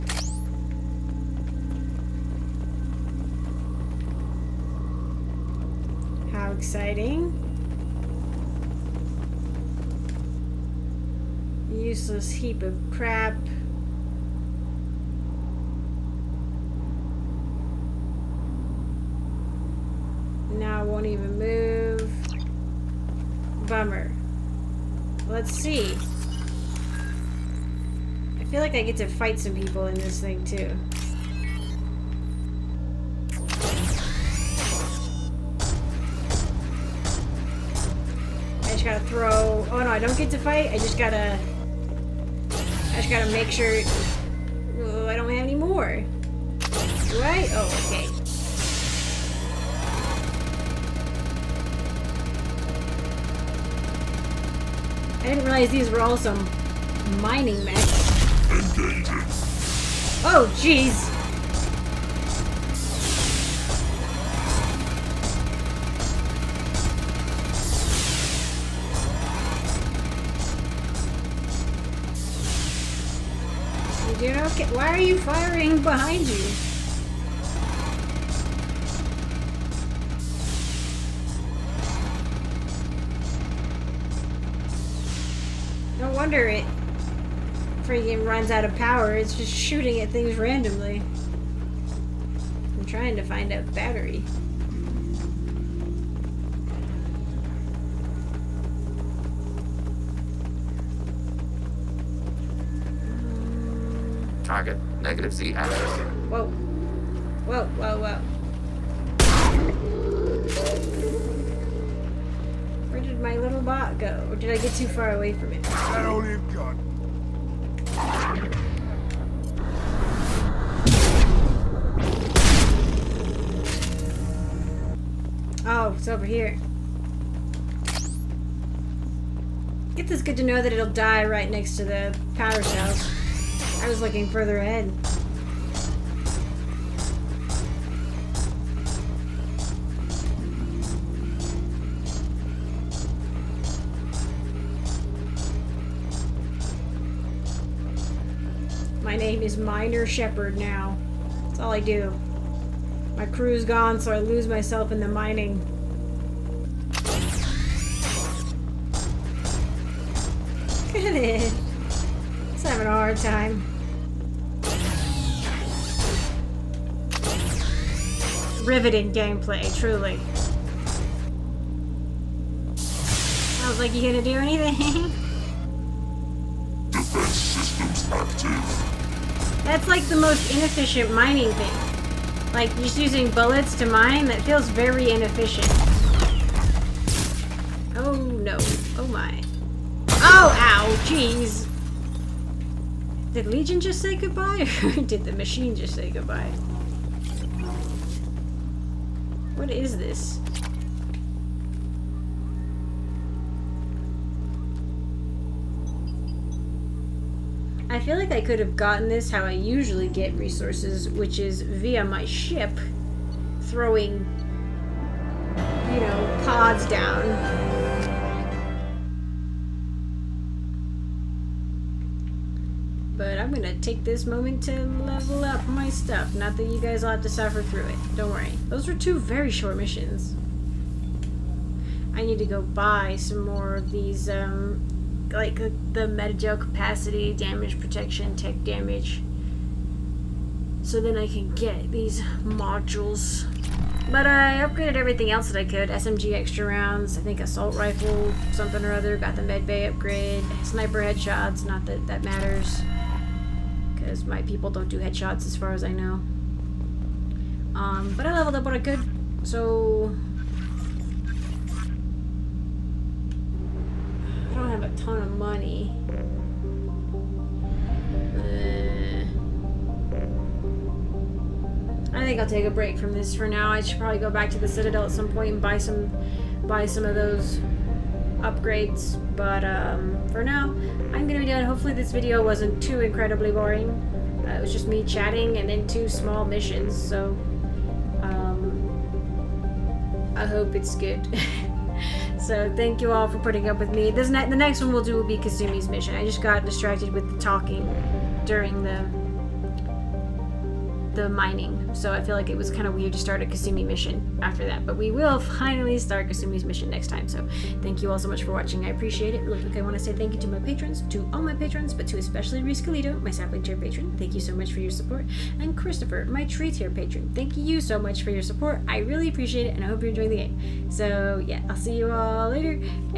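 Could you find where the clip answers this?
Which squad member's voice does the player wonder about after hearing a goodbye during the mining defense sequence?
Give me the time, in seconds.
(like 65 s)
193 s.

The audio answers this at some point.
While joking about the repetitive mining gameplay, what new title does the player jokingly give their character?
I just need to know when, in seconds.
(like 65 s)
149 s.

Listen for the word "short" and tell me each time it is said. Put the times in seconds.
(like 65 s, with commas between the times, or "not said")
229 s.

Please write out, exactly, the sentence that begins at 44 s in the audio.
Oh, I don't have any more.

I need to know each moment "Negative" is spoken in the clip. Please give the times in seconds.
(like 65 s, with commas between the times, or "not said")
105 s.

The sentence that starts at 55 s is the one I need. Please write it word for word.
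I didn't realize these were all some mining mechs.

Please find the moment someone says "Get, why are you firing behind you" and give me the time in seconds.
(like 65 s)
74 s.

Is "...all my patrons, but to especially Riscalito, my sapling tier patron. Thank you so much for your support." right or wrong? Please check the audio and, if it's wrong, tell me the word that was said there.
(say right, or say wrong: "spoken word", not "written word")
right.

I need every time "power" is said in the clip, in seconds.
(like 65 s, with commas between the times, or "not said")
88 s, 132 s.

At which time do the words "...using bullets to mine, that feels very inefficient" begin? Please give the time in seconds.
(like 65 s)
182 s.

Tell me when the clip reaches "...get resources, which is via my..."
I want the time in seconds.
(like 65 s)
210 s.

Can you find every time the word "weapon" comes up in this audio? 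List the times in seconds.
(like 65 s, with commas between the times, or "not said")
not said.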